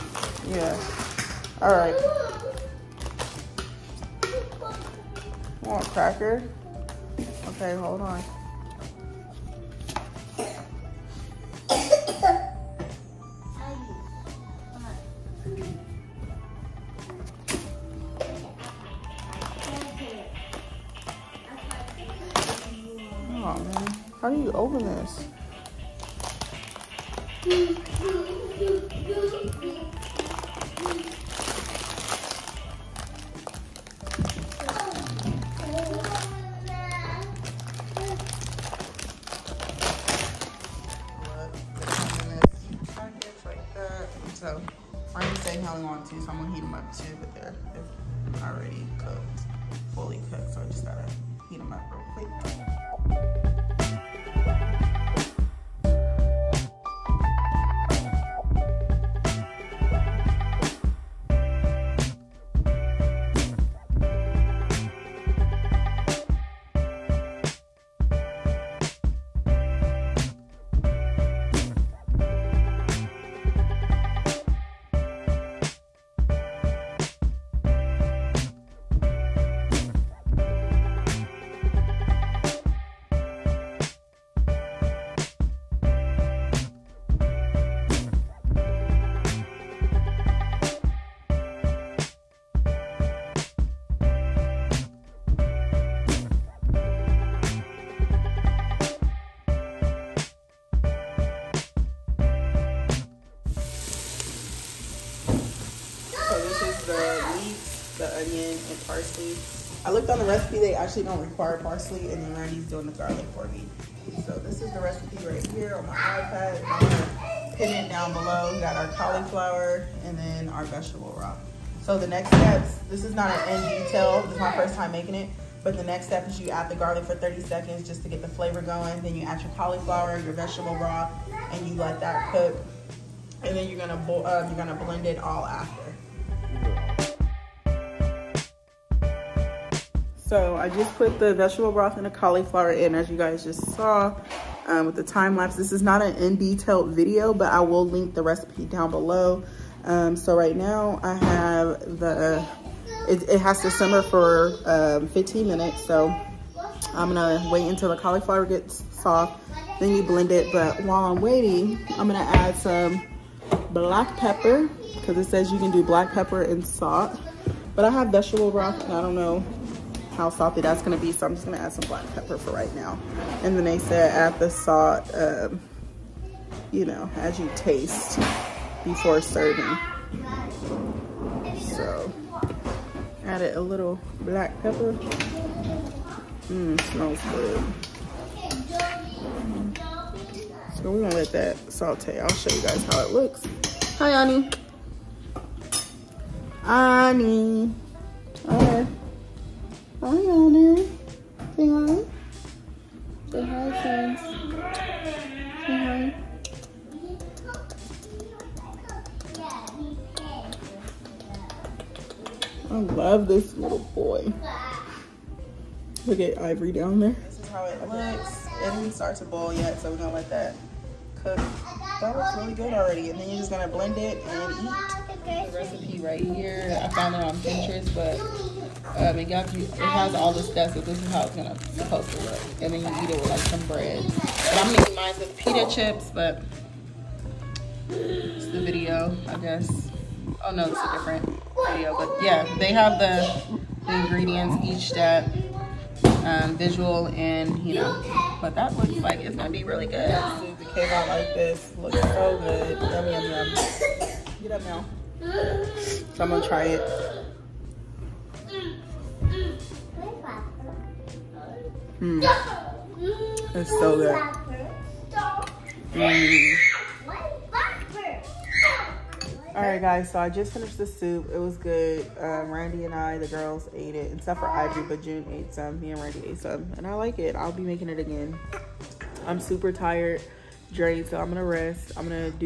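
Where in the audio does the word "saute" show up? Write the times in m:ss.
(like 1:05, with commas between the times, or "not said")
3:11.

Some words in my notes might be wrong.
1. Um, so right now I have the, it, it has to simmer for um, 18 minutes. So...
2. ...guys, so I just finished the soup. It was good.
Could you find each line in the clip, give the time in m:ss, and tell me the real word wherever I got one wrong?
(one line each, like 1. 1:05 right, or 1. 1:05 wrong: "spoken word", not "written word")
1. 2:29 wrong: "15", not "18"
2. 4:29 right.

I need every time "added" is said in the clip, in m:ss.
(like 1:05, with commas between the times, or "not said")
3:03.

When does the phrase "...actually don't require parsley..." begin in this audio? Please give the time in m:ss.
1:50.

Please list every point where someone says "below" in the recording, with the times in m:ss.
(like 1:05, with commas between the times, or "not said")
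1:58, 2:28.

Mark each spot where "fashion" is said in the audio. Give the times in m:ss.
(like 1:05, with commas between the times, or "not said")
not said.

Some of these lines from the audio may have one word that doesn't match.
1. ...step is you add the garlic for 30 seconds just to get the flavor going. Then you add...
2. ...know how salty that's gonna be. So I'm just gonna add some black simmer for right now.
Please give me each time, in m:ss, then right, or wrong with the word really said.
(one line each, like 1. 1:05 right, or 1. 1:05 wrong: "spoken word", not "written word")
1. 2:06 right
2. 2:49 wrong: "pepper", not "simmer".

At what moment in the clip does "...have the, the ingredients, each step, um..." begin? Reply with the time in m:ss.
4:02.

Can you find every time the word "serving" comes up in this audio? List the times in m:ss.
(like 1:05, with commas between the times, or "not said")
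2:59.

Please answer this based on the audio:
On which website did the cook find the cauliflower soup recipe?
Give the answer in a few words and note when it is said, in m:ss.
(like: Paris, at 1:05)
Pinterest, at 3:47.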